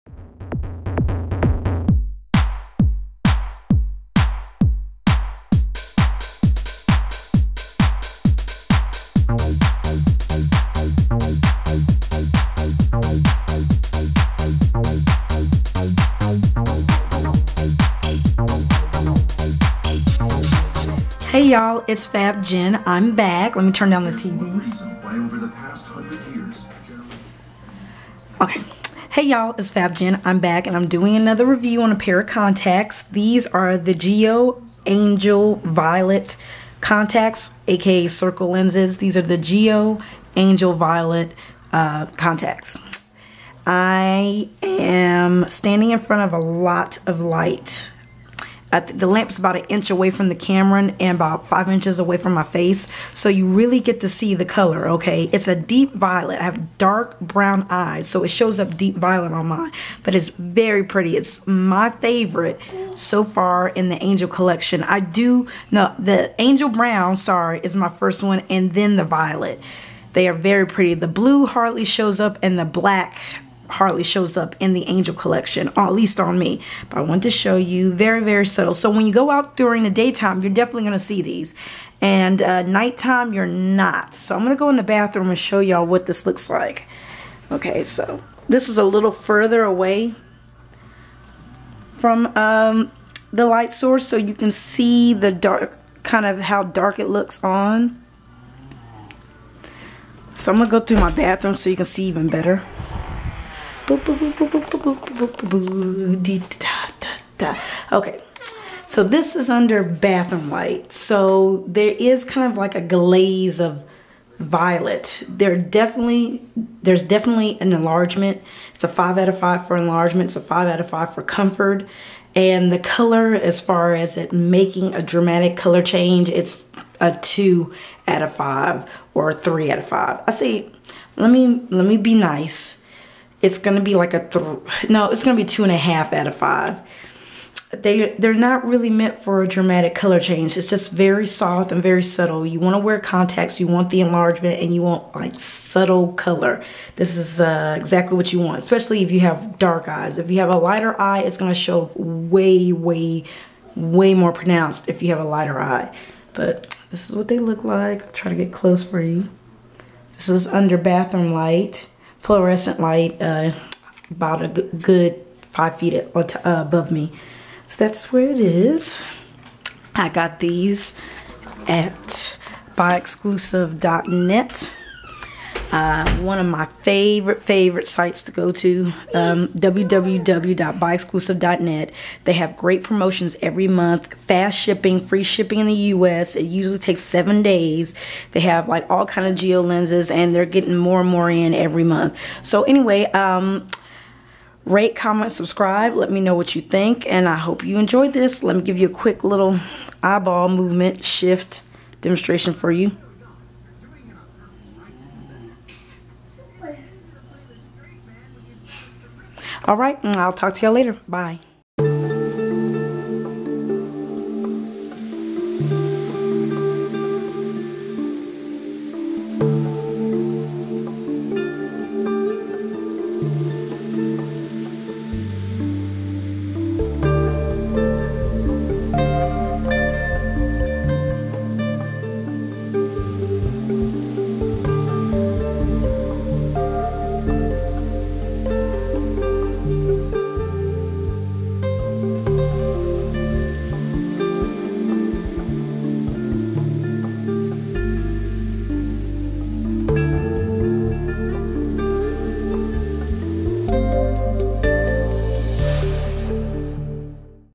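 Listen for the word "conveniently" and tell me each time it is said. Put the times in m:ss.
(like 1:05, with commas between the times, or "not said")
not said.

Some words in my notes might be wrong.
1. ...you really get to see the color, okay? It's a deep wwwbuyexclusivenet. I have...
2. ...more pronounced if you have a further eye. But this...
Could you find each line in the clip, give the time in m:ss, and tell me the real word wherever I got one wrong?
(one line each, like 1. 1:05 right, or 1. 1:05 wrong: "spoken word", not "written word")
1. 0:53 wrong: "violet", not "wwwbuyexclusivenet"
2. 2:34 wrong: "lighter", not "further".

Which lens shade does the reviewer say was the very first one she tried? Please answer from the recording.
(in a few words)
Angel Brown.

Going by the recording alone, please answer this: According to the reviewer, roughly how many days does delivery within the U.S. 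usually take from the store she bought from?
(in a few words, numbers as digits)
7 days.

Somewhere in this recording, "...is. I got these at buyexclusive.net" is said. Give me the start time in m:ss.
2:48.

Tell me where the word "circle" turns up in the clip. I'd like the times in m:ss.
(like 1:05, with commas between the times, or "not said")
0:38.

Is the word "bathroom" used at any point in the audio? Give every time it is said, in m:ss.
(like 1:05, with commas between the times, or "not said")
1:24, 1:41, 1:49, 2:40.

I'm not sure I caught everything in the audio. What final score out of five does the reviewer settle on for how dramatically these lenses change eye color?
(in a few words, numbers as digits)
2.5.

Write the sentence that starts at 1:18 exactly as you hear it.
So when you go out during the daytime, you're definitely going to see these.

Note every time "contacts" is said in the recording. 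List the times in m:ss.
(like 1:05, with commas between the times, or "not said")
0:32, 0:36, 0:42, 2:22.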